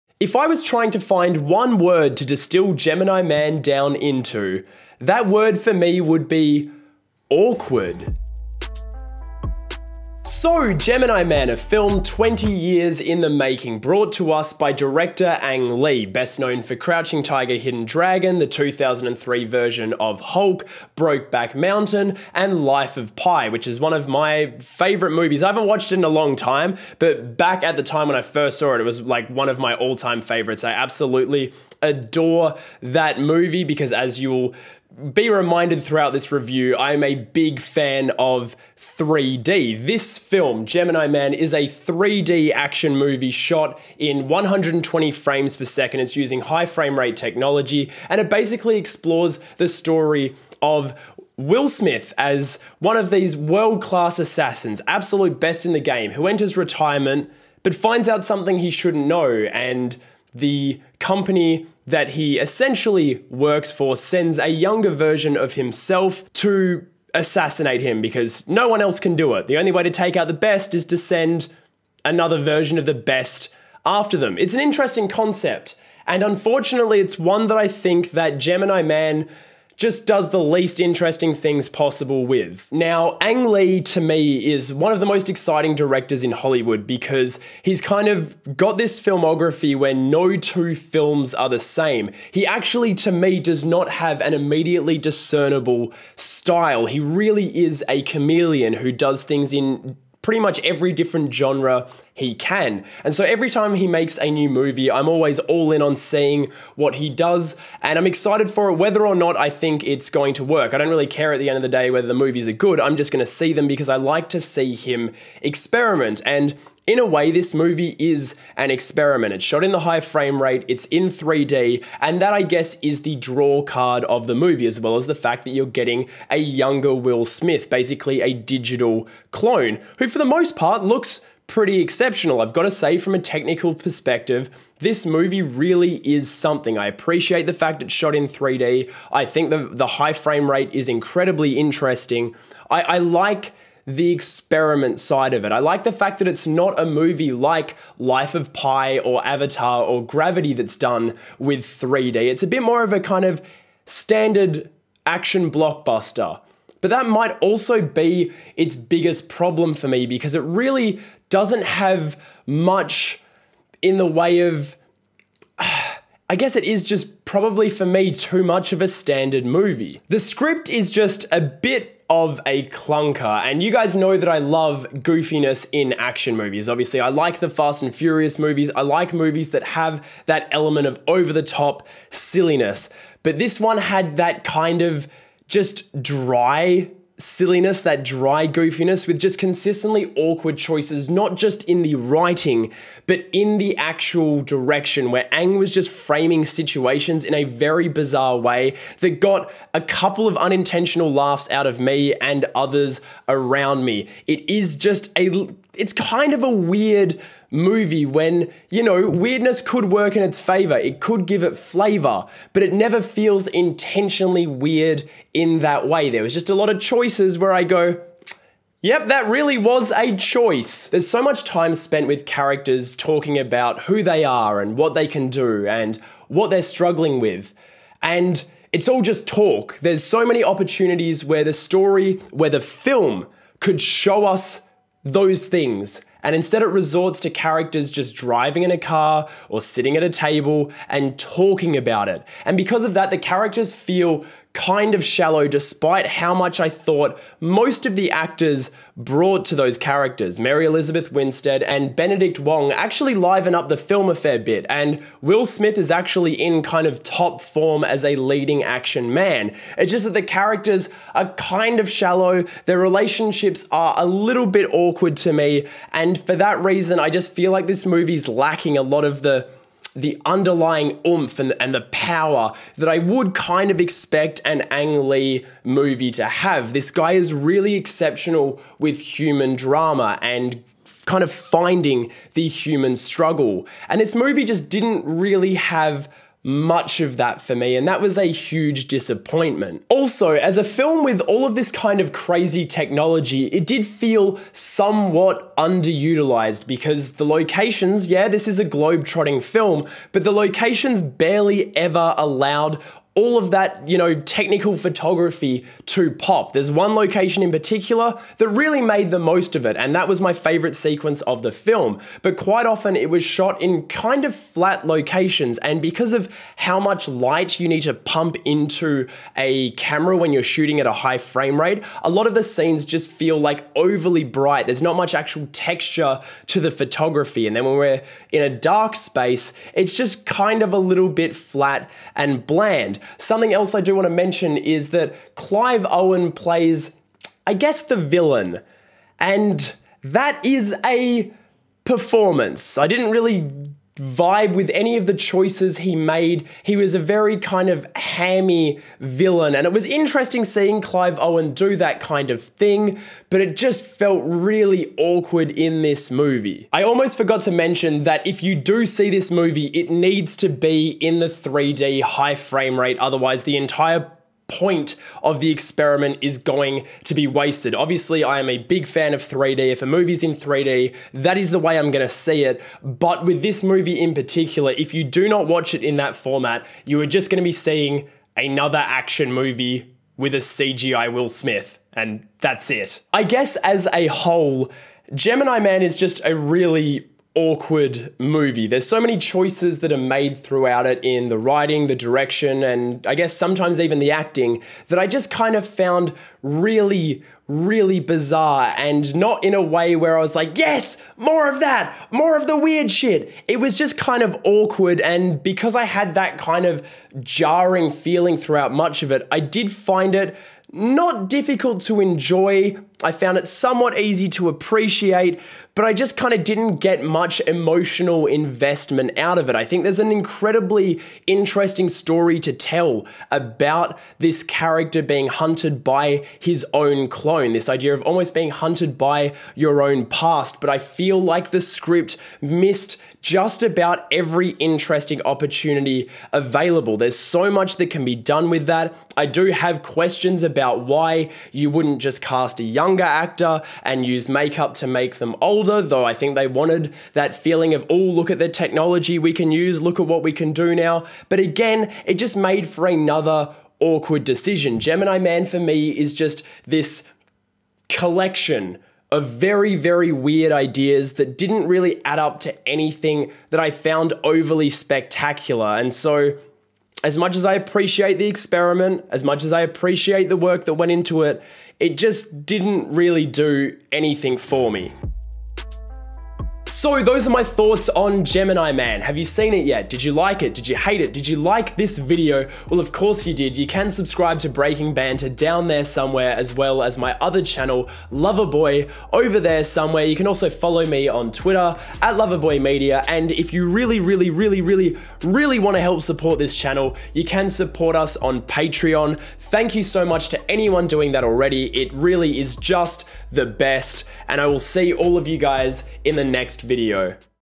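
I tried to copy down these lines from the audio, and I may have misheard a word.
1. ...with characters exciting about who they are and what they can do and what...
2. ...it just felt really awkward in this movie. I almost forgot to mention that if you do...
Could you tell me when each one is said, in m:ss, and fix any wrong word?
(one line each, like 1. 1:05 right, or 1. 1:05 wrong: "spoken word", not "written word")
1. 3:42 wrong: "talking", not "exciting"
2. 5:53 right.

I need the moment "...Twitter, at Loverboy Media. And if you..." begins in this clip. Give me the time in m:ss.
8:11.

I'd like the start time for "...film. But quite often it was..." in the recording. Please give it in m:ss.
5:11.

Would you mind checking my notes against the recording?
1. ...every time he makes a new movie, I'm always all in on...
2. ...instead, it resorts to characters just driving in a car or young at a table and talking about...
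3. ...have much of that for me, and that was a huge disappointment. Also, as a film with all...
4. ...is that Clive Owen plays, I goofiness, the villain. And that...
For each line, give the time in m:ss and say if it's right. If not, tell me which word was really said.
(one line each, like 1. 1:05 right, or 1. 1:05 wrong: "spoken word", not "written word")
1. 1:43 right
2. 3:56 wrong: "sitting", not "young"
3. 4:45 right
4. 5:34 wrong: "guess", not "goofiness".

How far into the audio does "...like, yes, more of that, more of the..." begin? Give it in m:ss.
6:40.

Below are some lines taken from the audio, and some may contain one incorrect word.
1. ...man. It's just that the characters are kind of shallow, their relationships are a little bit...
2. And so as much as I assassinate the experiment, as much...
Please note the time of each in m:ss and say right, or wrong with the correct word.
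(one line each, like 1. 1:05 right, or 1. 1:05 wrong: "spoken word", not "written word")
1. 4:19 right
2. 7:45 wrong: "appreciate", not "assassinate".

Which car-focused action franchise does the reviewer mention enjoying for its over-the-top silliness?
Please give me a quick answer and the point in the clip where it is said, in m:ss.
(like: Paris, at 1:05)
Fast and Furious, at 2:57.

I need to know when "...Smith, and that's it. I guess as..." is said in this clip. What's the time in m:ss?
6:21.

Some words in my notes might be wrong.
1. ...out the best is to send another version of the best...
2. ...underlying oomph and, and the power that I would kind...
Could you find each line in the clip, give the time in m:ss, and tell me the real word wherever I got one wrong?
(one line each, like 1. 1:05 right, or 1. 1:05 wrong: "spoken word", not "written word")
1. 1:10 right
2. 4:30 right.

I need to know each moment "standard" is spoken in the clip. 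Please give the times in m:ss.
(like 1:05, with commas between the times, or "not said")
2:33, 2:48.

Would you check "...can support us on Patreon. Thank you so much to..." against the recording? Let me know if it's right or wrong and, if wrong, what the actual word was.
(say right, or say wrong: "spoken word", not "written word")
right.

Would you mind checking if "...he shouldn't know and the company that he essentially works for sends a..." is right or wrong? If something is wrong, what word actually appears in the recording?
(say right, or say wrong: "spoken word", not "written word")
right.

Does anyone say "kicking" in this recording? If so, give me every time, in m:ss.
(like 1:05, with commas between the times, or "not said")
not said.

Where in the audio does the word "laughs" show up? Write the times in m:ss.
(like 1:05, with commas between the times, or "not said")
3:21.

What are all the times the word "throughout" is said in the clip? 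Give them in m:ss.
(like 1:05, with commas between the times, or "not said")
0:35, 6:30, 6:48.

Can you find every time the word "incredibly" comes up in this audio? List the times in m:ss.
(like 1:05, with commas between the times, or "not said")
2:20, 7:00.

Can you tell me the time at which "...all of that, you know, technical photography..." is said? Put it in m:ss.
5:03.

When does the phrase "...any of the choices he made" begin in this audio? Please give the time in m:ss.
5:44.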